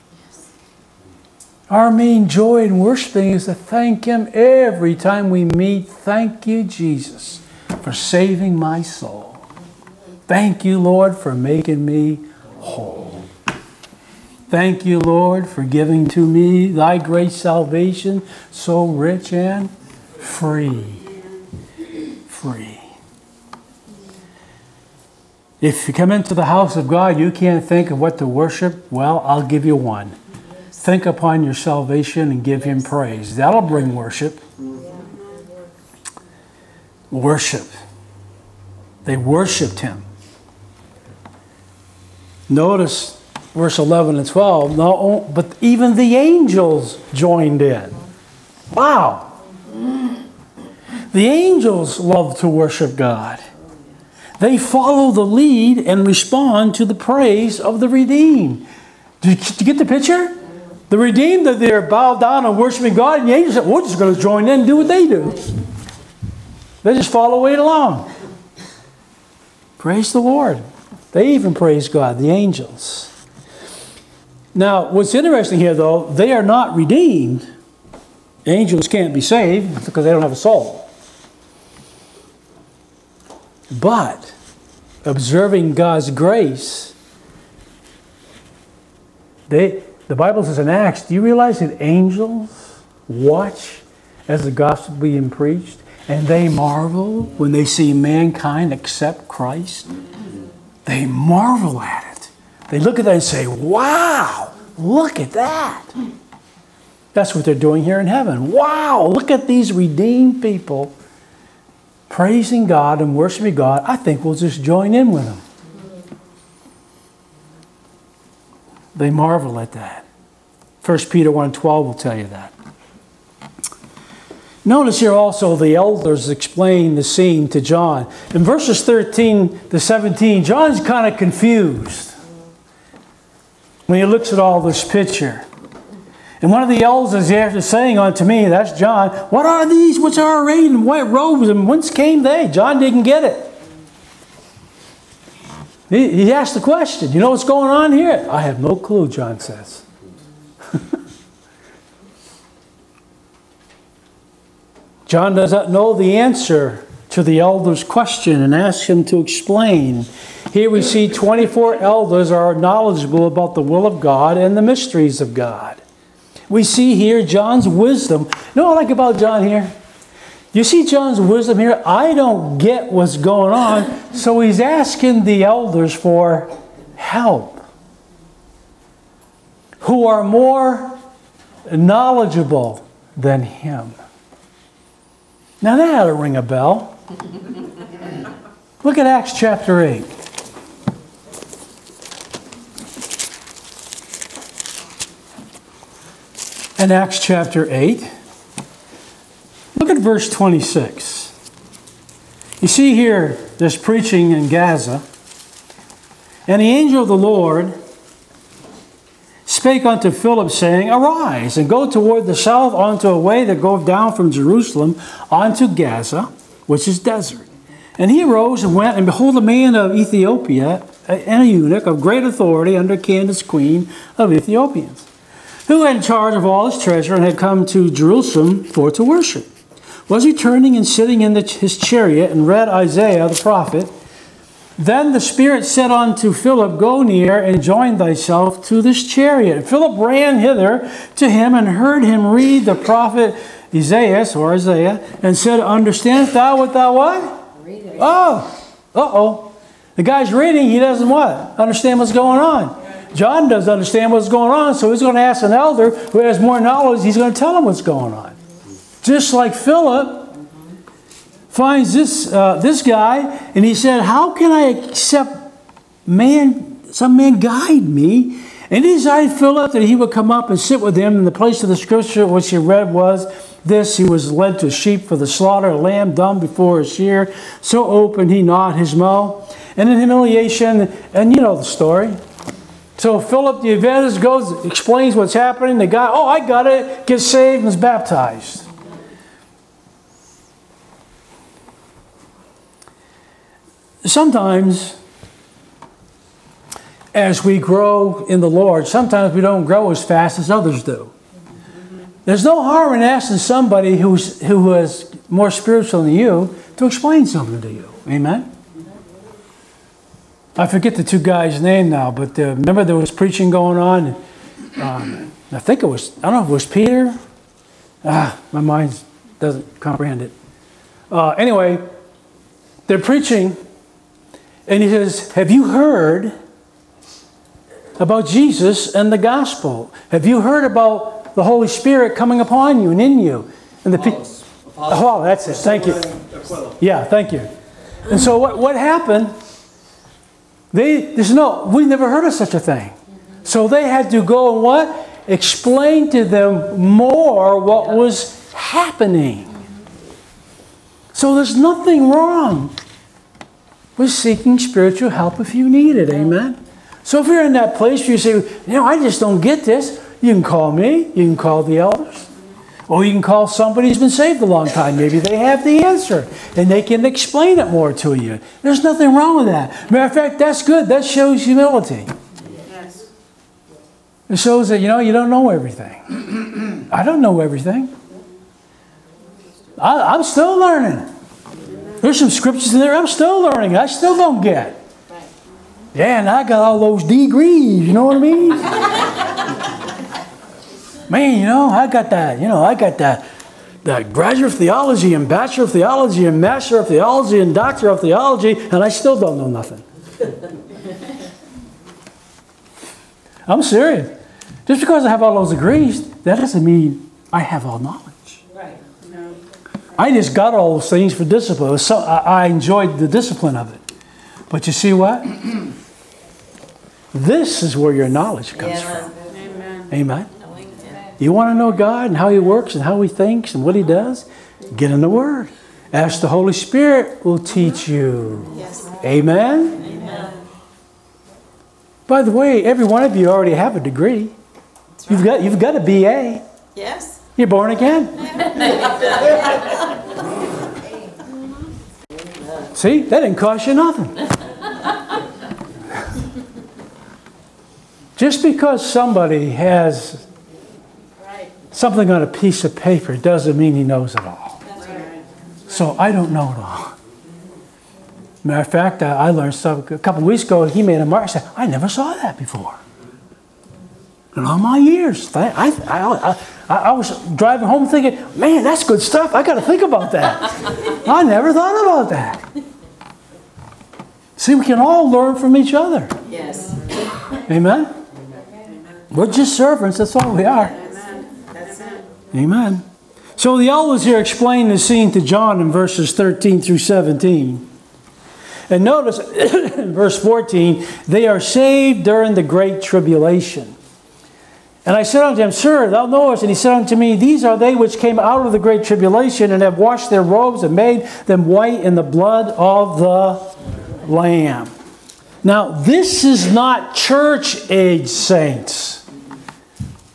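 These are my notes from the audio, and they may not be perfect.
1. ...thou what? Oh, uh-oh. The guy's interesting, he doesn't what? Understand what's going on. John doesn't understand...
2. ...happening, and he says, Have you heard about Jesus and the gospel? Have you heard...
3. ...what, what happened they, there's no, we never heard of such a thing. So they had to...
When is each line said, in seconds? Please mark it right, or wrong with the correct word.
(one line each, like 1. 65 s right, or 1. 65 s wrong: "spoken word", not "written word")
1. 246 s wrong: "reading", not "interesting"
2. 322 s wrong: "preaching", not "happening"
3. 338 s right.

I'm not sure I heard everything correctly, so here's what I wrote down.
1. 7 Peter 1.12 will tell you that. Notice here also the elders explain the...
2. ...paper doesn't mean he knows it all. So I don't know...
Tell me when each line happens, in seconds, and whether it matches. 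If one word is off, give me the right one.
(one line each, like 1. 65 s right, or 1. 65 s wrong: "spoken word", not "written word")
1. 120 s wrong: "1", not "7"
2. 452 s right.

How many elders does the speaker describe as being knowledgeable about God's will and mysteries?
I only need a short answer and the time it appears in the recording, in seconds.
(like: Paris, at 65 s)
24, at 161 s.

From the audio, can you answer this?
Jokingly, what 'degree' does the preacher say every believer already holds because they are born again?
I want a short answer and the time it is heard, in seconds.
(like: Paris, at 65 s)
BA, at 435 s.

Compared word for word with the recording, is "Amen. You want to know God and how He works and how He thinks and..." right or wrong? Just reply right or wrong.
right.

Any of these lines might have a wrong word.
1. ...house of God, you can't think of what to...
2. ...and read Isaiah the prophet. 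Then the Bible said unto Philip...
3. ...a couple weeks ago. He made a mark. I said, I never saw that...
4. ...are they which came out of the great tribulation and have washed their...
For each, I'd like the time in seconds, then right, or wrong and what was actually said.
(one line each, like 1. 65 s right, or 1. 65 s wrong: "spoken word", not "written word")
1. 26 s right
2. 232 s wrong: "Spirit", not "Bible"
3. 459 s right
4. 497 s right.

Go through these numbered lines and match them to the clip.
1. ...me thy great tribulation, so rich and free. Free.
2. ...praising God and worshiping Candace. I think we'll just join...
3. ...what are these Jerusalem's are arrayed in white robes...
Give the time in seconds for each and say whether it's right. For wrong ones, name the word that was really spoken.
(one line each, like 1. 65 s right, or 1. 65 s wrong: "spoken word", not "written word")
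1. 16 s wrong: "salvation", not "tribulation"
2. 112 s wrong: "God", not "Candace"
3. 139 s wrong: "What", not "Jerusalem".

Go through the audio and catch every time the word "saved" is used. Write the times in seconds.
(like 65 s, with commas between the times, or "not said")
79 s, 287 s, 364 s, 491 s.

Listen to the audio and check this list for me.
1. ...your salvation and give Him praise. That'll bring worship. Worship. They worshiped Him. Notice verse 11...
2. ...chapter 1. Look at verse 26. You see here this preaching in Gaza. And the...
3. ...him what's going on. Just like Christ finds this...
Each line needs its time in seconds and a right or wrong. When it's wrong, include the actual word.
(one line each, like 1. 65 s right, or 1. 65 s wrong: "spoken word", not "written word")
1. 31 s right
2. 197 s wrong: "8", not "1"
3. 257 s wrong: "Philip", not "Christ".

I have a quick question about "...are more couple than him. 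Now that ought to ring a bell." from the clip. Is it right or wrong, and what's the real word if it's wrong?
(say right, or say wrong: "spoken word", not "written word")
wrong: "knowledgeable", not "couple".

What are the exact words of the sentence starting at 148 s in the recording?
I have no clue, John says.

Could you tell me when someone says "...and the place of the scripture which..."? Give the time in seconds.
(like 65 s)
271 s.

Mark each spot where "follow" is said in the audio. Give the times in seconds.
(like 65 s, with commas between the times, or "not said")
54 s, 67 s.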